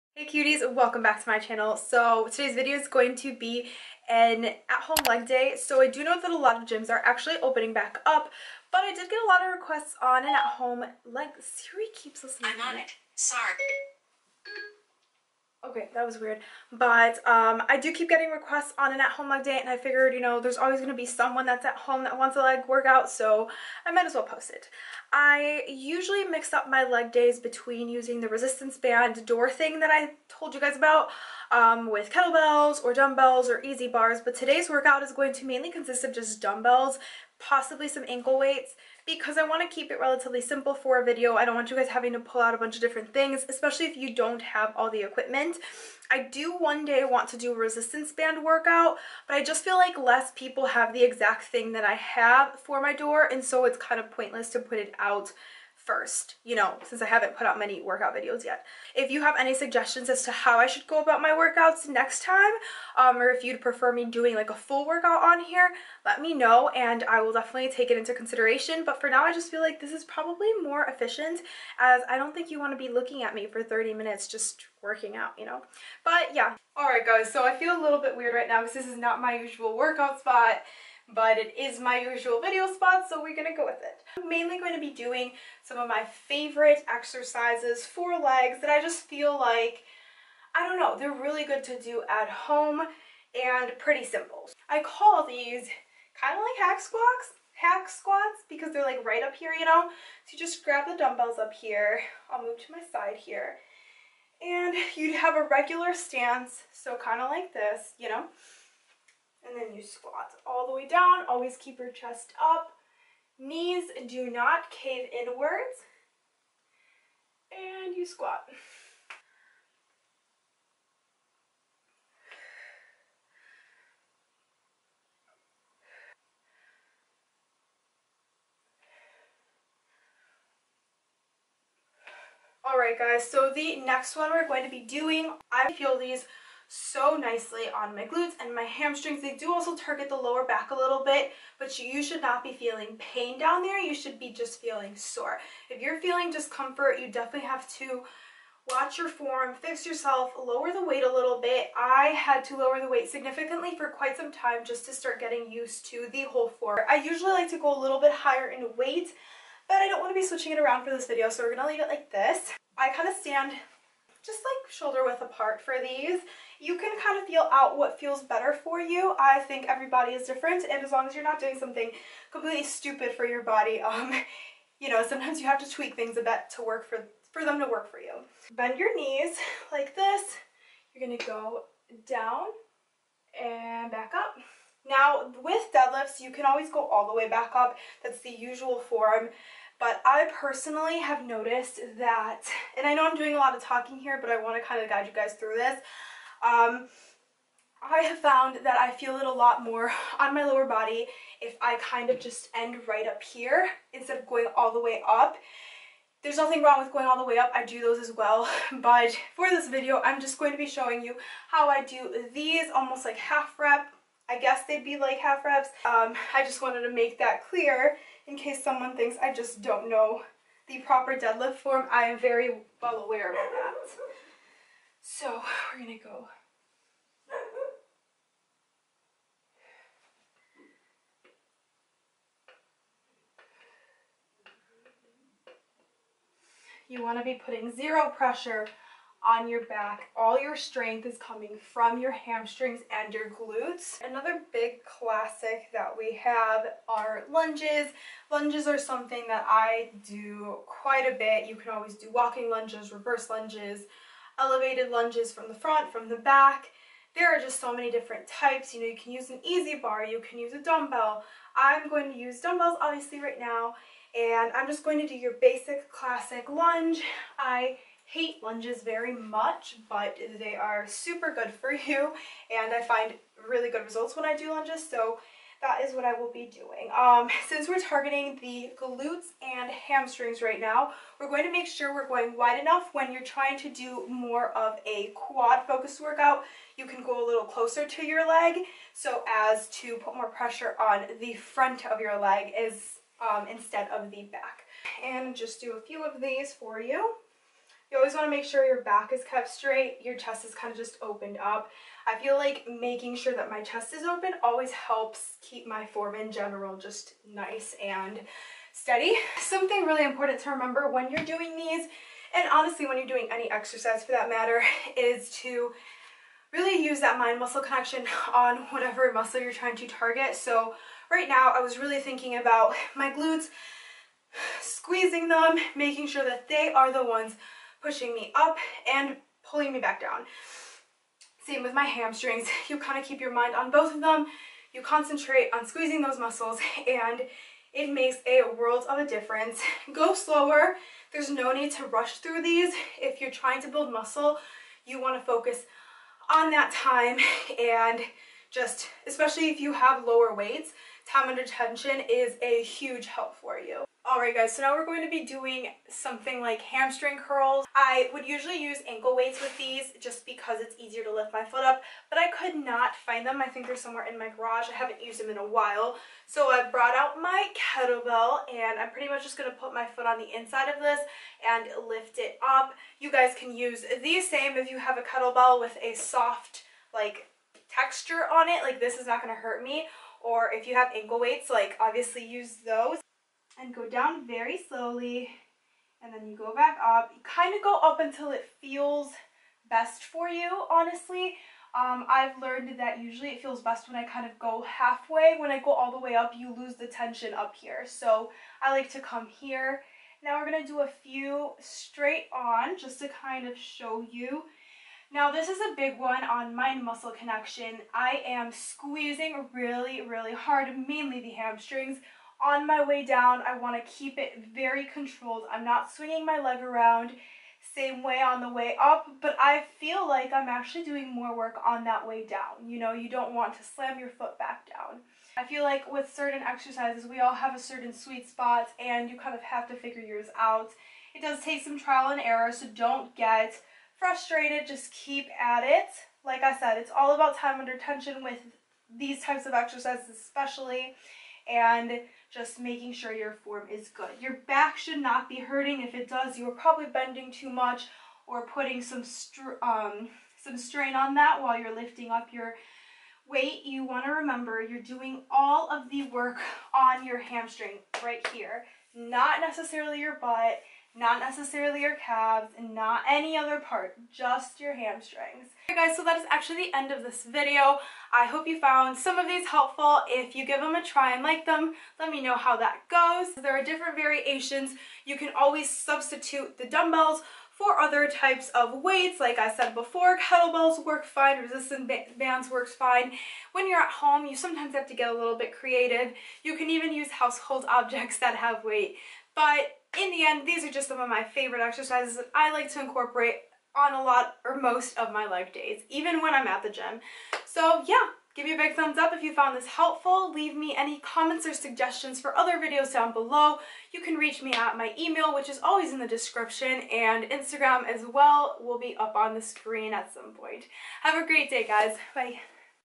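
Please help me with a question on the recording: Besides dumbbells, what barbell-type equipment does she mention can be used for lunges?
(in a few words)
EZ bar.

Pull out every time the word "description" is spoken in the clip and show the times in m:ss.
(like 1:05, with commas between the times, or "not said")
8:26.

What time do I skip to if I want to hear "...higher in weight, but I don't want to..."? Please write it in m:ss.
2:38.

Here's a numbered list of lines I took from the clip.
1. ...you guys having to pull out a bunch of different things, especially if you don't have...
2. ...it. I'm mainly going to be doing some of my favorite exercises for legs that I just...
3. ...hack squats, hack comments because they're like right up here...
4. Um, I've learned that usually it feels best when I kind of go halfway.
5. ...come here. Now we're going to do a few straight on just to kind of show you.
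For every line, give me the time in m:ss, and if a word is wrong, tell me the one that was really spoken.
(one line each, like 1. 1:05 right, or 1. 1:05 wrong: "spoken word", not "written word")
1. 0:41 right
2. 1:23 right
3. 1:36 wrong: "squats", not "comments"
4. 6:31 right
5. 6:38 right.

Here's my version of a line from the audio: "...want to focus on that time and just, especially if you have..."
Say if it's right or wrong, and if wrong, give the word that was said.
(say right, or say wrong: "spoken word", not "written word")
right.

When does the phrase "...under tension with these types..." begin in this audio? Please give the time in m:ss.
7:17.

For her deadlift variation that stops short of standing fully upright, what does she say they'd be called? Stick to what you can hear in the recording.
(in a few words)
half reps.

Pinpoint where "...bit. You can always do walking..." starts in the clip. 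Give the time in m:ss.
4:11.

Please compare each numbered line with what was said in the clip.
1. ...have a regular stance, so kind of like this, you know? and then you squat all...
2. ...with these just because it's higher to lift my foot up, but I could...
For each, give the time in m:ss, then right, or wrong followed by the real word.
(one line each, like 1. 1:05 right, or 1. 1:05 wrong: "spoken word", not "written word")
1. 1:45 right
2. 5:59 wrong: "easier", not "higher".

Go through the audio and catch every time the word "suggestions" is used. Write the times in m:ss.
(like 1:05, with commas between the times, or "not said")
0:59, 8:21.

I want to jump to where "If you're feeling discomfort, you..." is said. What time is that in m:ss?
2:25.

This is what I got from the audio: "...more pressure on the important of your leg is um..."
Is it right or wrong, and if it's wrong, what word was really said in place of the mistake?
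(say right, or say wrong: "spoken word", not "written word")
wrong: "front", not "important".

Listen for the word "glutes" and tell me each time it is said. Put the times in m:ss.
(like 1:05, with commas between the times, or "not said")
2:18, 4:03, 4:38, 5:23.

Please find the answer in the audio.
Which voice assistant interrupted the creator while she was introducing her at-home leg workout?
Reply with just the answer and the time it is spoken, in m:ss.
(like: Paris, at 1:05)
Siri, at 0:11.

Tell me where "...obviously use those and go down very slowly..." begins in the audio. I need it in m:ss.
6:21.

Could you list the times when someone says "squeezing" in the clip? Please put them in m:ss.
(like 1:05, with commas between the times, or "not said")
5:24, 5:35, 6:48.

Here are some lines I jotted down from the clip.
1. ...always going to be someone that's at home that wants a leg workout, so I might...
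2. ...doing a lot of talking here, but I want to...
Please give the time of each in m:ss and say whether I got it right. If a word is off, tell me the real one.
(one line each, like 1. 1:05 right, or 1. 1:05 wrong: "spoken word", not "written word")
1. 0:20 right
2. 3:13 right.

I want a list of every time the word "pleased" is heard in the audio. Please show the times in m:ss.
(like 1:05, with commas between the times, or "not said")
not said.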